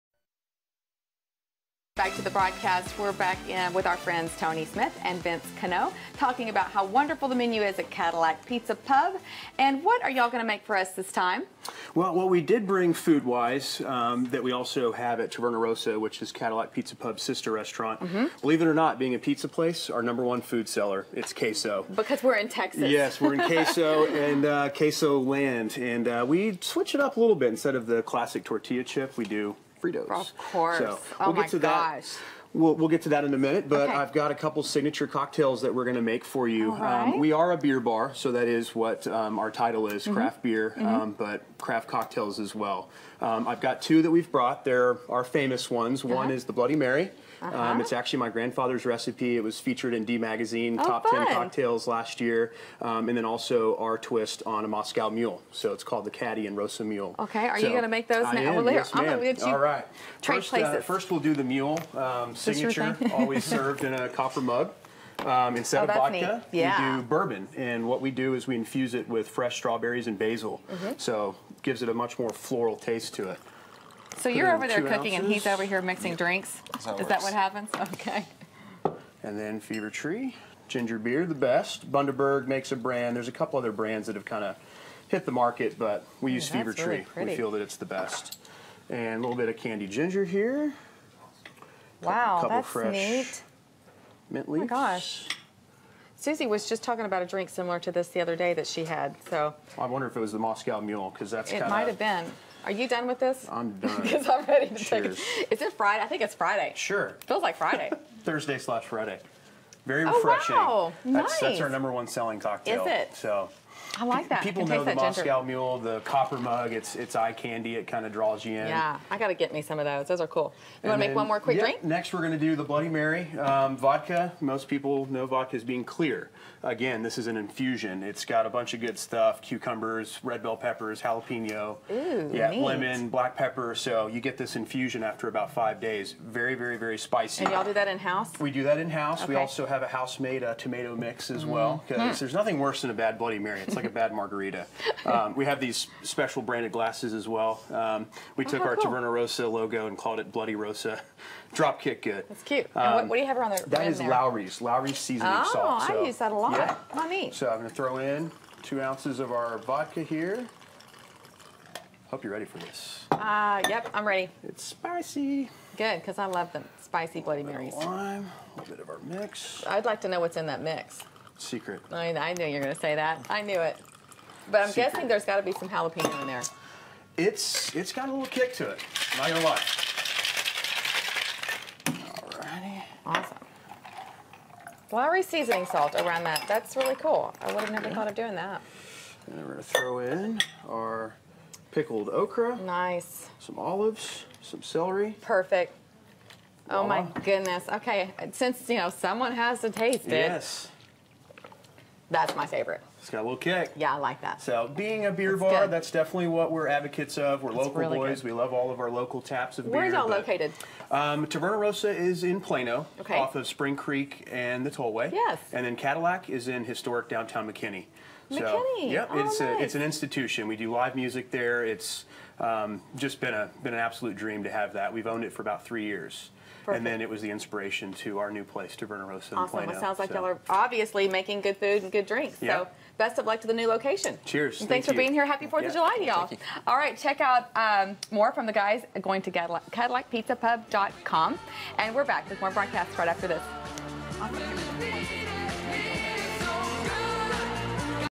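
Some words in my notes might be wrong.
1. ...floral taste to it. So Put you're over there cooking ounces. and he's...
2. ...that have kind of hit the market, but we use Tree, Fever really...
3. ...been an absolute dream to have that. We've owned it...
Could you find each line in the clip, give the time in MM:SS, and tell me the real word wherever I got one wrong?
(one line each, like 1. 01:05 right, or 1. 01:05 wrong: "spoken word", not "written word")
1. 01:12 right
2. 01:24 wrong: "Ooh", not "Tree"
3. 03:43 right.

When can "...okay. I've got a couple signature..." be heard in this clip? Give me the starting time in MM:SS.
00:33.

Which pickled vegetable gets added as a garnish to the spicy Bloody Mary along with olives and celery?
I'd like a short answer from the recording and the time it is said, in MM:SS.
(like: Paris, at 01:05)
Okra, at 03:11.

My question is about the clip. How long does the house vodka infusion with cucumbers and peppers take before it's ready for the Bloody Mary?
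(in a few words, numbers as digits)
5 days.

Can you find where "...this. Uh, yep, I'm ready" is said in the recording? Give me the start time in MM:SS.
02:42.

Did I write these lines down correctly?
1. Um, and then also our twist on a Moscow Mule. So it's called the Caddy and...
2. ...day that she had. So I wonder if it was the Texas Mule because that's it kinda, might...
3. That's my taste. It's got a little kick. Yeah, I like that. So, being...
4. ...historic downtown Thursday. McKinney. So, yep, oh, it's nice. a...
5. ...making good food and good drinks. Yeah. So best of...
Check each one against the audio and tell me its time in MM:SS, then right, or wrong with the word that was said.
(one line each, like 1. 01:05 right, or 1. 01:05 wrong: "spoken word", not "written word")
1. 00:52 right
2. 01:38 wrong: "Moscow", not "Texas"
3. 03:22 wrong: "favorite", not "taste"
4. 03:36 wrong: "McKinney", not "Thursday"
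5. 03:51 right.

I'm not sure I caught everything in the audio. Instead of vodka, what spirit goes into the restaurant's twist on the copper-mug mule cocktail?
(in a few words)
Bourbon.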